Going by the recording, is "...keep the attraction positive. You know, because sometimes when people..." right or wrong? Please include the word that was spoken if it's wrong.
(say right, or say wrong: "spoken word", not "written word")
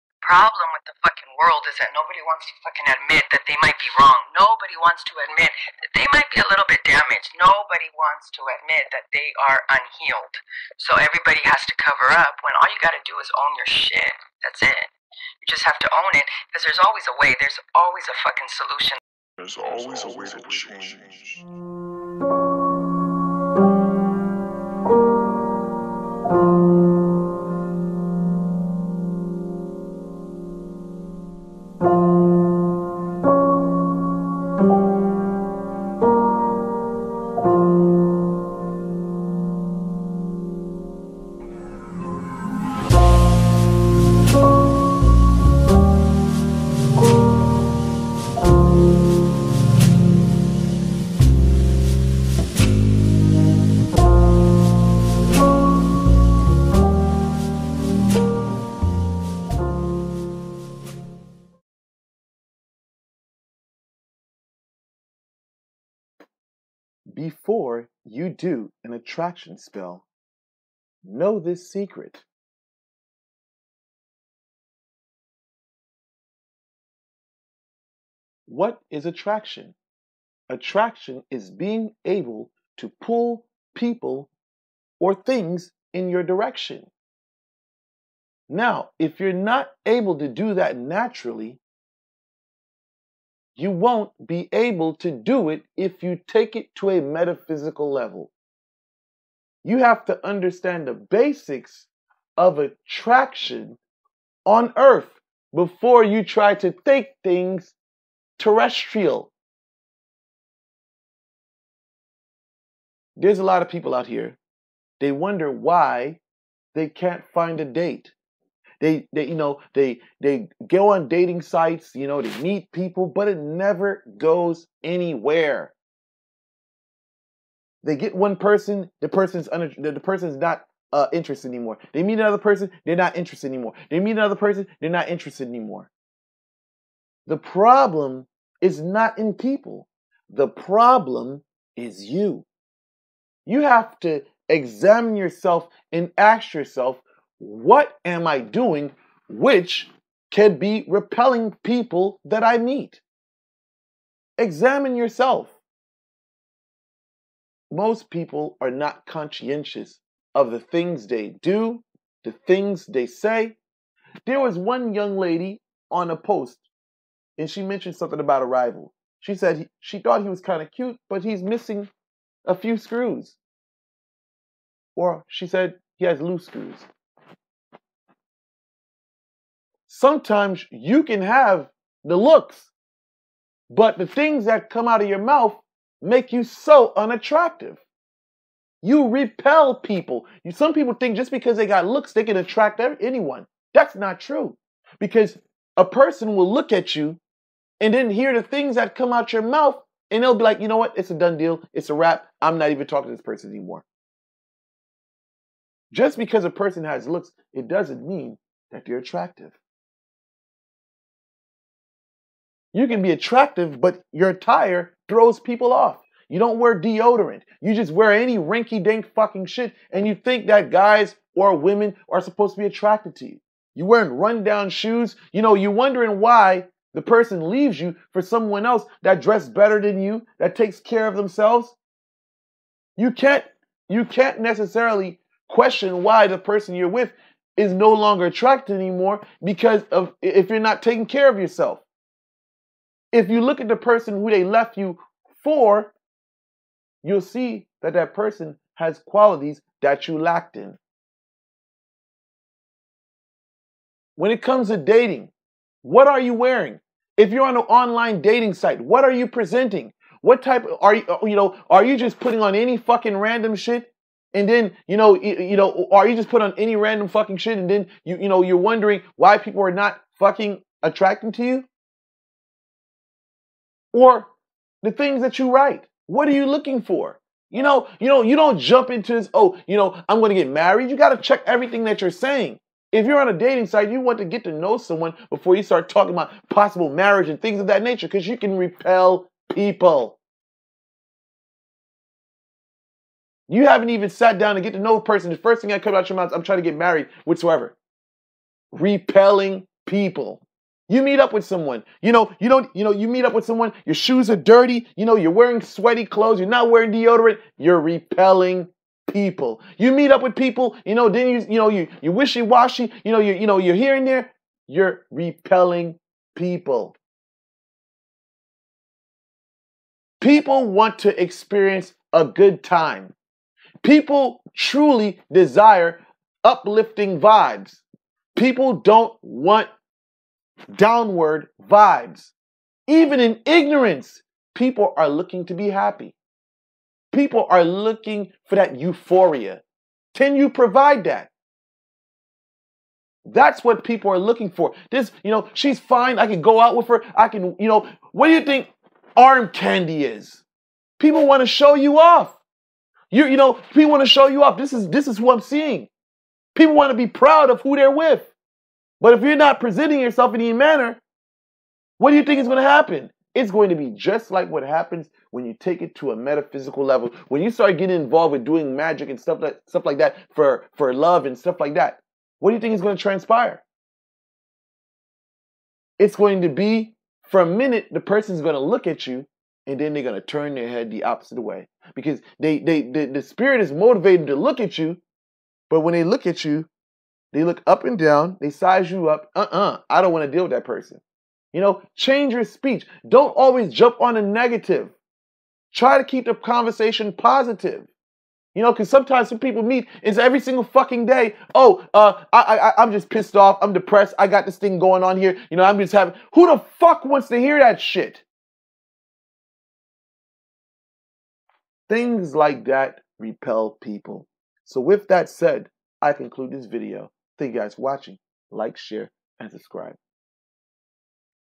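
wrong: "conversation", not "attraction".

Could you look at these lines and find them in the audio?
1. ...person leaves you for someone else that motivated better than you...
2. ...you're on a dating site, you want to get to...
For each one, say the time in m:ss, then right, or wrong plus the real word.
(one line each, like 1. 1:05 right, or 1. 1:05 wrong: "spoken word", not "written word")
1. 3:47 wrong: "dressed", not "motivated"
2. 4:43 right.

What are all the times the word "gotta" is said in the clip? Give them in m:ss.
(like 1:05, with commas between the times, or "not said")
0:12, 4:40.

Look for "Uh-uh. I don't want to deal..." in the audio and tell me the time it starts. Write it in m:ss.
6:29.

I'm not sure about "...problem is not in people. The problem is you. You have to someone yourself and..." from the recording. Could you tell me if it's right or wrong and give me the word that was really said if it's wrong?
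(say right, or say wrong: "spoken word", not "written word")
wrong: "examine", not "someone".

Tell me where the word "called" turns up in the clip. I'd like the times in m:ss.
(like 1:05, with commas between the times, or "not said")
not said.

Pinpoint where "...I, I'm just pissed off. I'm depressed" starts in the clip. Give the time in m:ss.
6:42.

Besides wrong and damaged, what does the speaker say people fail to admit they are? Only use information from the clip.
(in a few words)
unhealed.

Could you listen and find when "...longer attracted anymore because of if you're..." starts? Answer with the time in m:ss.
3:57.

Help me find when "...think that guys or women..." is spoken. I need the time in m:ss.
3:40.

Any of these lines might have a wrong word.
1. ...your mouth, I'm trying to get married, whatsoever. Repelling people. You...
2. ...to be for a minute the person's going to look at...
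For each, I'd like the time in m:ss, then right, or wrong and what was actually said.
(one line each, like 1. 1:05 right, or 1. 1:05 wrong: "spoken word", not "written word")
1. 4:56 right
2. 6:16 right.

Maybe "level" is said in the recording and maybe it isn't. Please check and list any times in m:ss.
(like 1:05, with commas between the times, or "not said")
1:37, 6:06.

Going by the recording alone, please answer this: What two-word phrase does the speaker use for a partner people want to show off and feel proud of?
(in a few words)
arm candy.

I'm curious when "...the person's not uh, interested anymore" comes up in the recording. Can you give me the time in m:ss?
2:09.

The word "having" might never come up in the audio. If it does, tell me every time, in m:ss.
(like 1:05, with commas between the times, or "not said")
6:45.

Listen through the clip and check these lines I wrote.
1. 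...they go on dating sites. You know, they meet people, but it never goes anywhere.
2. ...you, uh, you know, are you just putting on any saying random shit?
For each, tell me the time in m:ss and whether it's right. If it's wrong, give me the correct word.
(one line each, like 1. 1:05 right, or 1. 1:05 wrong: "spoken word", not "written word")
1. 2:00 right
2. 4:20 wrong: "fucking", not "saying".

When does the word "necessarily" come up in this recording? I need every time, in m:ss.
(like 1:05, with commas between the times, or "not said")
3:54.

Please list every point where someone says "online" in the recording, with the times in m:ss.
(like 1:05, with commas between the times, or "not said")
4:17.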